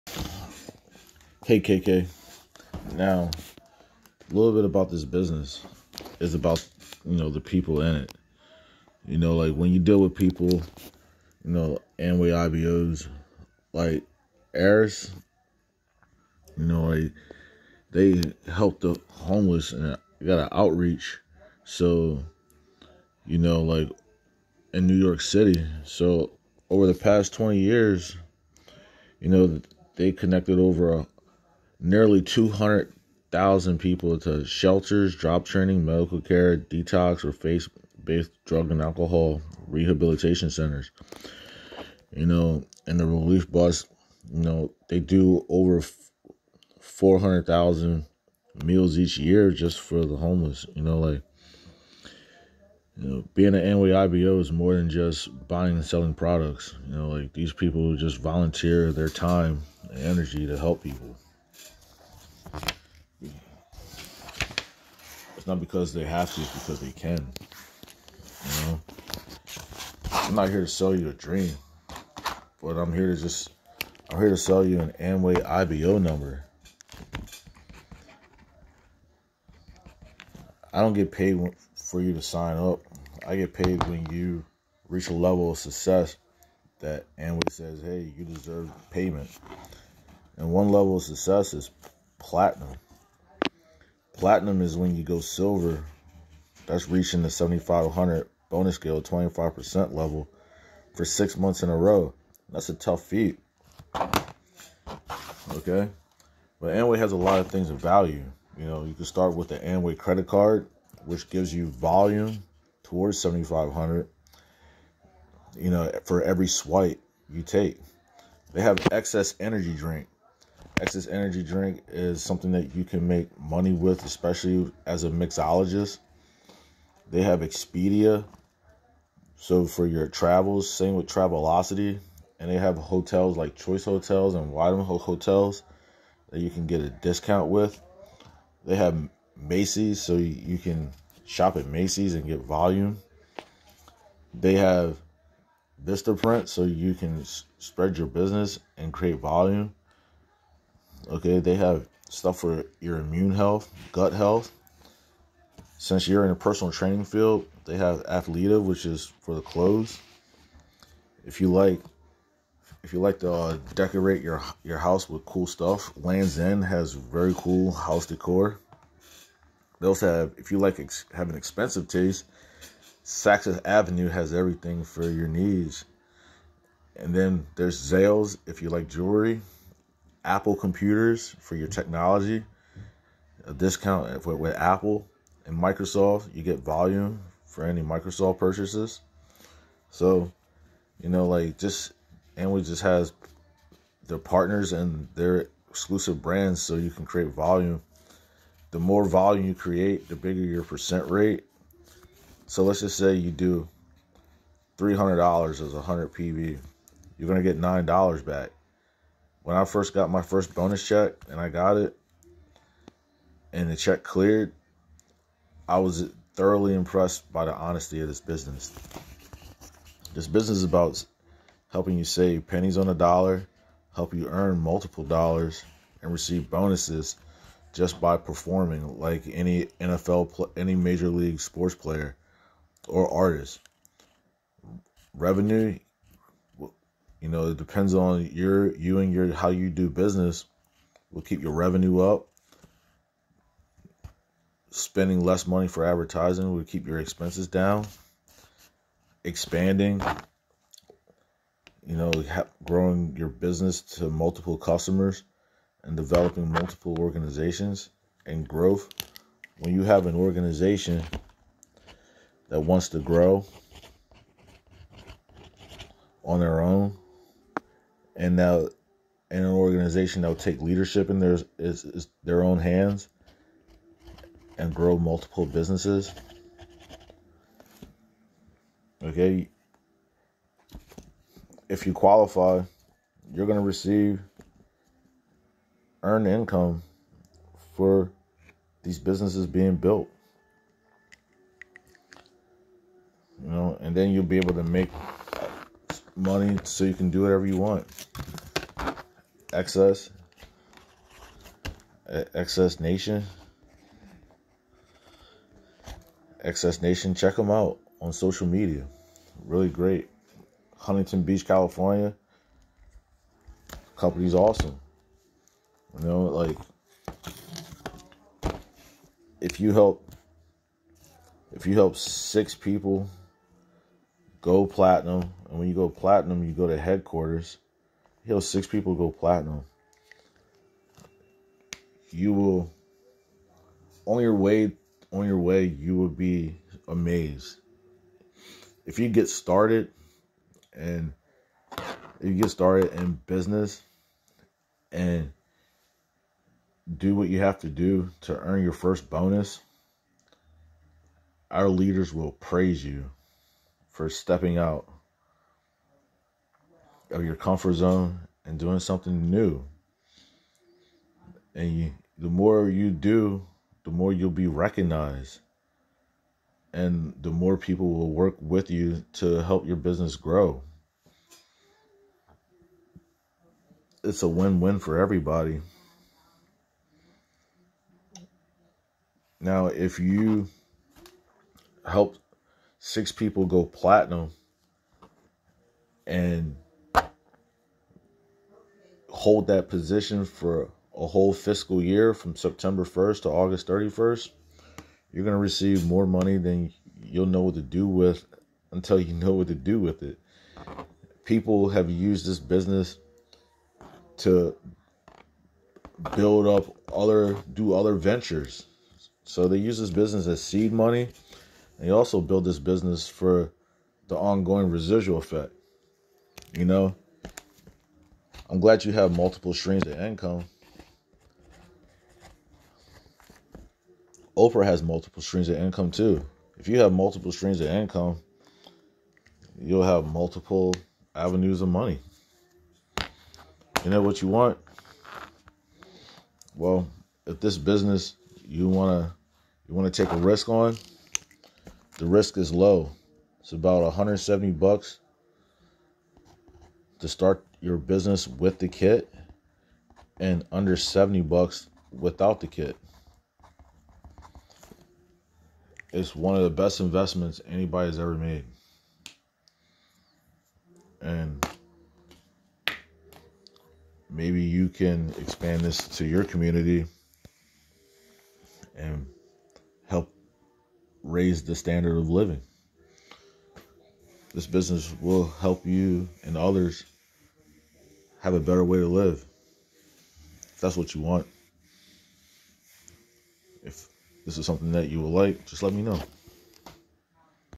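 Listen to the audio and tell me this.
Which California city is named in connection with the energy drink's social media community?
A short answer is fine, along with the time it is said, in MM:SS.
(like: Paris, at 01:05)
Huntington Beach, at 05:10.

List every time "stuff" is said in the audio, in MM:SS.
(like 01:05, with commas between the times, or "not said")
02:32, 02:45.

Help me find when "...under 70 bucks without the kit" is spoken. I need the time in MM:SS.
07:30.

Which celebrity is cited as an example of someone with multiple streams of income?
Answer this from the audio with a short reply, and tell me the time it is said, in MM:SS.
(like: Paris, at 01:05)
Oprah, at 07:04.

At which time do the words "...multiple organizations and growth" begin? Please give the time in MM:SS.
04:16.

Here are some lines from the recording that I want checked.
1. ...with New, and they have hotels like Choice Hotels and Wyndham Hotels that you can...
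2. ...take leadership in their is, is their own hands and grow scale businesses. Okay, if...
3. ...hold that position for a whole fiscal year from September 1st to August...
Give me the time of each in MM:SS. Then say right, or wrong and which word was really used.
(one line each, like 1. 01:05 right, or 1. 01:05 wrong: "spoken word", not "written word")
1. 02:10 wrong: "Travelocity", not "New"
2. 04:30 wrong: "multiple", not "scale"
3. 06:29 right.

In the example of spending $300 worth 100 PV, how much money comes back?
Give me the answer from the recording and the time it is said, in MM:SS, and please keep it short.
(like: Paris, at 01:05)
$9, at 03:27.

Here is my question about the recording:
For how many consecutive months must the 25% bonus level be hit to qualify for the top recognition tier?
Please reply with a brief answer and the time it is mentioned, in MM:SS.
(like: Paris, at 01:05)
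6, at 01:41.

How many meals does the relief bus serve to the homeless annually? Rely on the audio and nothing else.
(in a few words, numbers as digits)
over 400,000.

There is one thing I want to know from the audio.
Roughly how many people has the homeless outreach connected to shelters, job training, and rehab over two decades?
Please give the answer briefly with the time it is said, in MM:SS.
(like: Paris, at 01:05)
nearly 200,000, at 00:31.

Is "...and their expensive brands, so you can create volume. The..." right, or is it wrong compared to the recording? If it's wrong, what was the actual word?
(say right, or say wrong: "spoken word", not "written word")
wrong: "exclusive", not "expensive".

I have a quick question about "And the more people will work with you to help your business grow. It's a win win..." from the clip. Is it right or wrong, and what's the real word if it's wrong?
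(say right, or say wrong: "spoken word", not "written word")
right.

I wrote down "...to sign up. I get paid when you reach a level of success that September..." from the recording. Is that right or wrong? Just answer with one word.
wrong.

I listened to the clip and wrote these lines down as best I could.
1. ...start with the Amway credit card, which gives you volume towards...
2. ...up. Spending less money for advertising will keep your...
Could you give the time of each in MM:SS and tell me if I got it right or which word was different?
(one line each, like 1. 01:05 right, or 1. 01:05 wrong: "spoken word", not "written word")
1. 01:49 right
2. 04:01 right.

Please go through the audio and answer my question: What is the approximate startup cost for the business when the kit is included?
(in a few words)
about $170.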